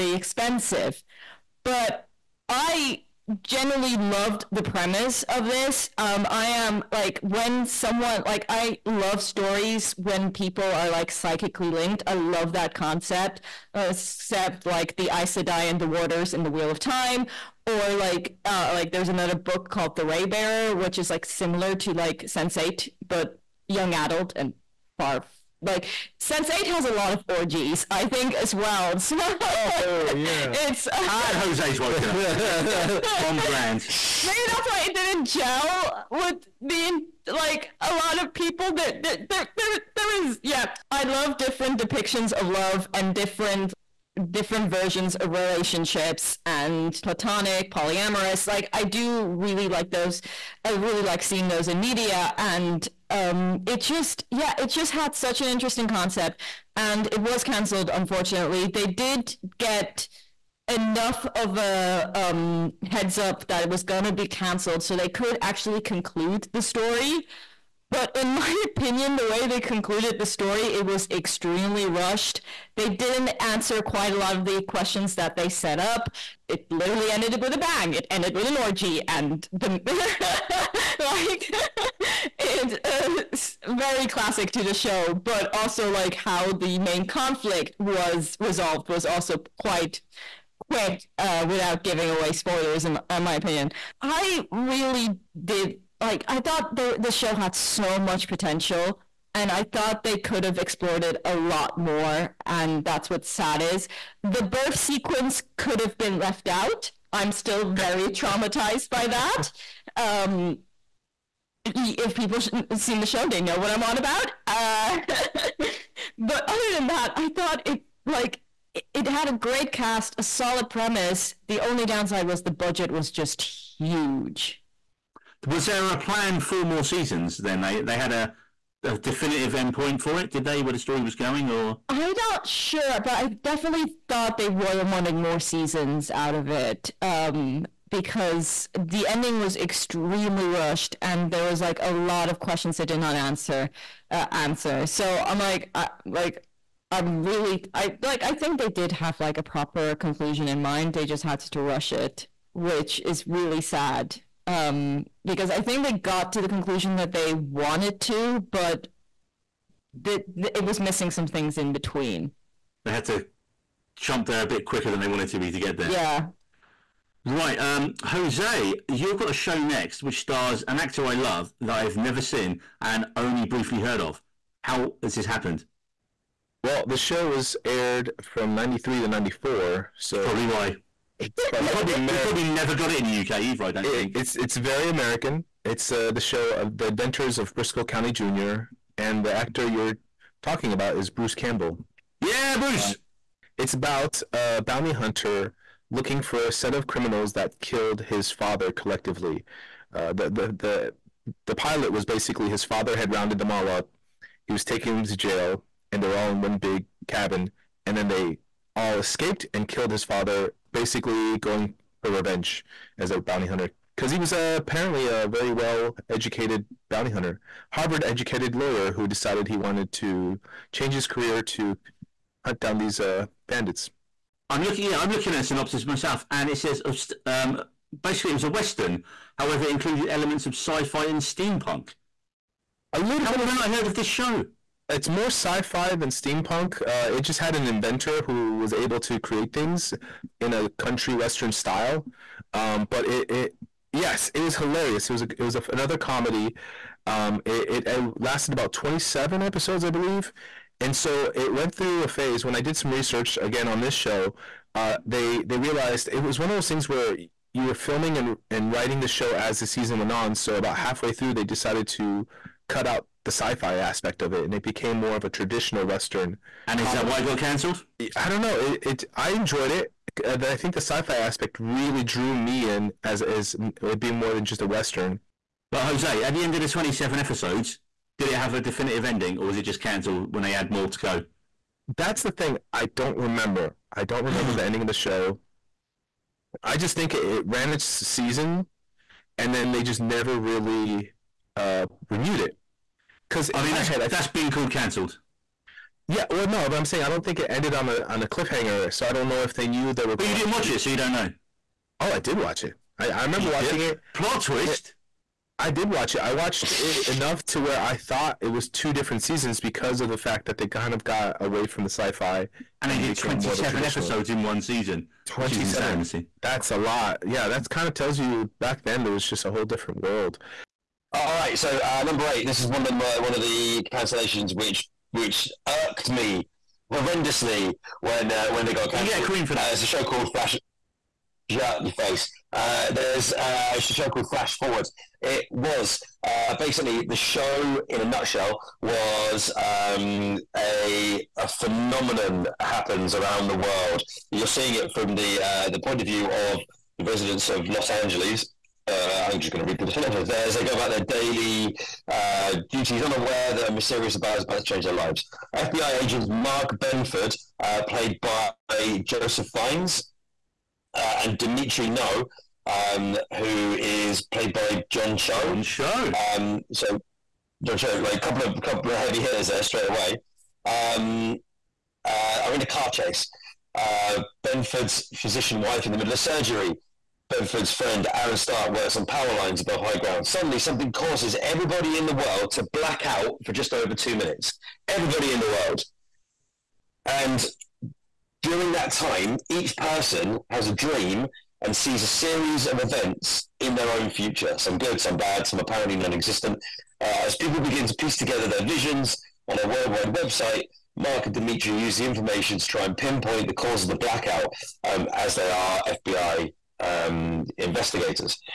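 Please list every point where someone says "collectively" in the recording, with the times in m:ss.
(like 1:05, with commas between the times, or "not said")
3:18.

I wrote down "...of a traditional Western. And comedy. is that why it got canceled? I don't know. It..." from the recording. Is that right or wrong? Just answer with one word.
right.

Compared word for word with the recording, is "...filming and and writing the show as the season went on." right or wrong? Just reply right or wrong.
right.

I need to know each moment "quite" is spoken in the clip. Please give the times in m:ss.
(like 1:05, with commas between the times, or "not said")
1:13, 1:29.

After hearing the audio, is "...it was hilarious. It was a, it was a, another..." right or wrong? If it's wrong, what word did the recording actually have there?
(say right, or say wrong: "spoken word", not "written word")
right.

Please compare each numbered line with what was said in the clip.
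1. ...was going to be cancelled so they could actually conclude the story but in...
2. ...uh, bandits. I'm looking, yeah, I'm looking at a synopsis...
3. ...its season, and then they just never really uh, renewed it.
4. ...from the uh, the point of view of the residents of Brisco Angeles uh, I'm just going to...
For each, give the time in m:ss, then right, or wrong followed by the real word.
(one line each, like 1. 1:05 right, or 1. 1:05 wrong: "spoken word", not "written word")
1. 1:03 right
2. 3:42 right
3. 4:47 right
4. 5:44 wrong: "Los", not "Brisco".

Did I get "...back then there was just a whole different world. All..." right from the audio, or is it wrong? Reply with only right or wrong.
right.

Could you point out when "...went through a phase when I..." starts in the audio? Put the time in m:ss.
4:11.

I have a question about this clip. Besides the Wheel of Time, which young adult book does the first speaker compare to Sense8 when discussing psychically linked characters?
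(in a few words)
The Raybearer.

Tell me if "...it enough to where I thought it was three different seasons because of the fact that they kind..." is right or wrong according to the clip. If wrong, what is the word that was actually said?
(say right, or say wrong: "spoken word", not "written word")
wrong: "two", not "three".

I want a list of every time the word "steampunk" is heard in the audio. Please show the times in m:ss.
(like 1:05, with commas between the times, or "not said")
3:51, 3:56.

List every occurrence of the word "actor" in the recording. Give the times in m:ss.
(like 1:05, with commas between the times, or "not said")
2:50, 3:09.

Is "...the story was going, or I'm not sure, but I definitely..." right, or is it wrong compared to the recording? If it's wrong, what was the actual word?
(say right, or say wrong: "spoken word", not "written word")
right.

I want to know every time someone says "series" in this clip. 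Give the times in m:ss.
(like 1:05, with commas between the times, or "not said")
6:32.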